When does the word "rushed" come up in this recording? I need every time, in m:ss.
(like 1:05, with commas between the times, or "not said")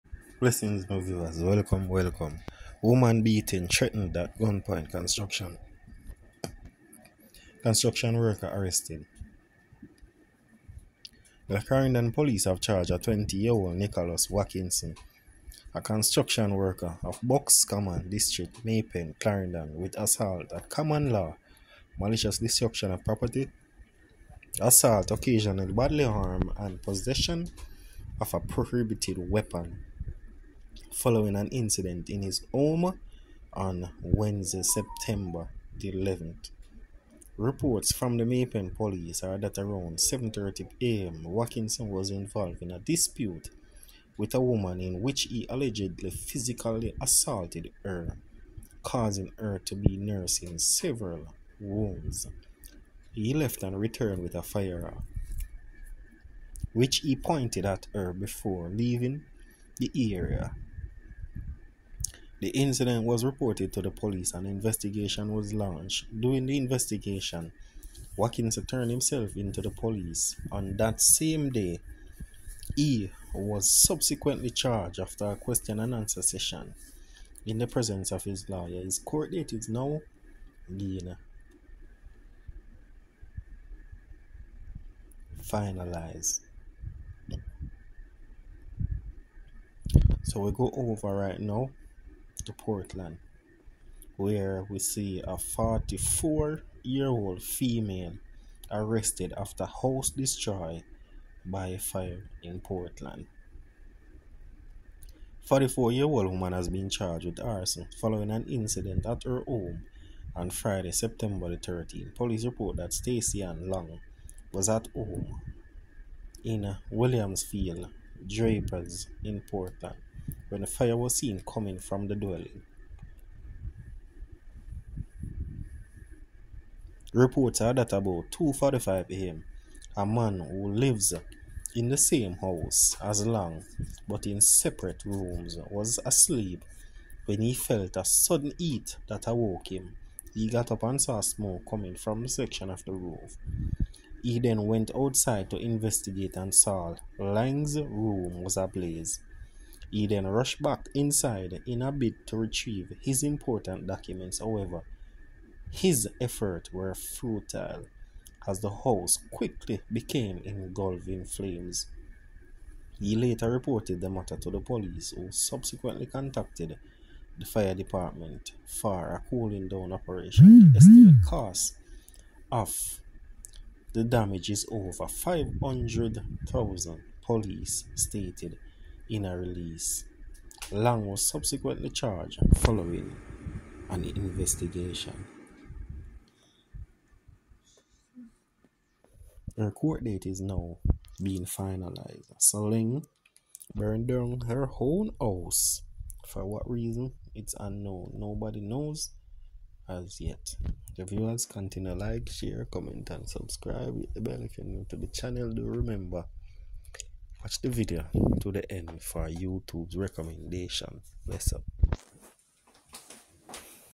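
2:30.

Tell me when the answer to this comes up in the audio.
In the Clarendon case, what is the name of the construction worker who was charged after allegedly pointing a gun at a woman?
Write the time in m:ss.
0:13.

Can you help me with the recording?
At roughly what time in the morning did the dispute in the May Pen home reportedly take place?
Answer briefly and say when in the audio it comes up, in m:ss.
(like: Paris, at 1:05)
7:30 a.m., at 0:39.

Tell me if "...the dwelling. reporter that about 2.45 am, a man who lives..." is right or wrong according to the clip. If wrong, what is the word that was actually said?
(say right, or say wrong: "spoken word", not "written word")
right.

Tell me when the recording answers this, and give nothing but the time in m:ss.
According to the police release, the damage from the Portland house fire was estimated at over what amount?
2:55.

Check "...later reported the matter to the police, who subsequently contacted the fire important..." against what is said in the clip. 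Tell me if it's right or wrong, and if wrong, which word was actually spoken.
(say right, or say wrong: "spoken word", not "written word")
wrong: "department", not "important".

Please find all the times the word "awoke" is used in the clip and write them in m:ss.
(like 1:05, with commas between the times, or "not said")
2:19.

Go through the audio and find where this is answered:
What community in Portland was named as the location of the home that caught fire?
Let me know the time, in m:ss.
1:56.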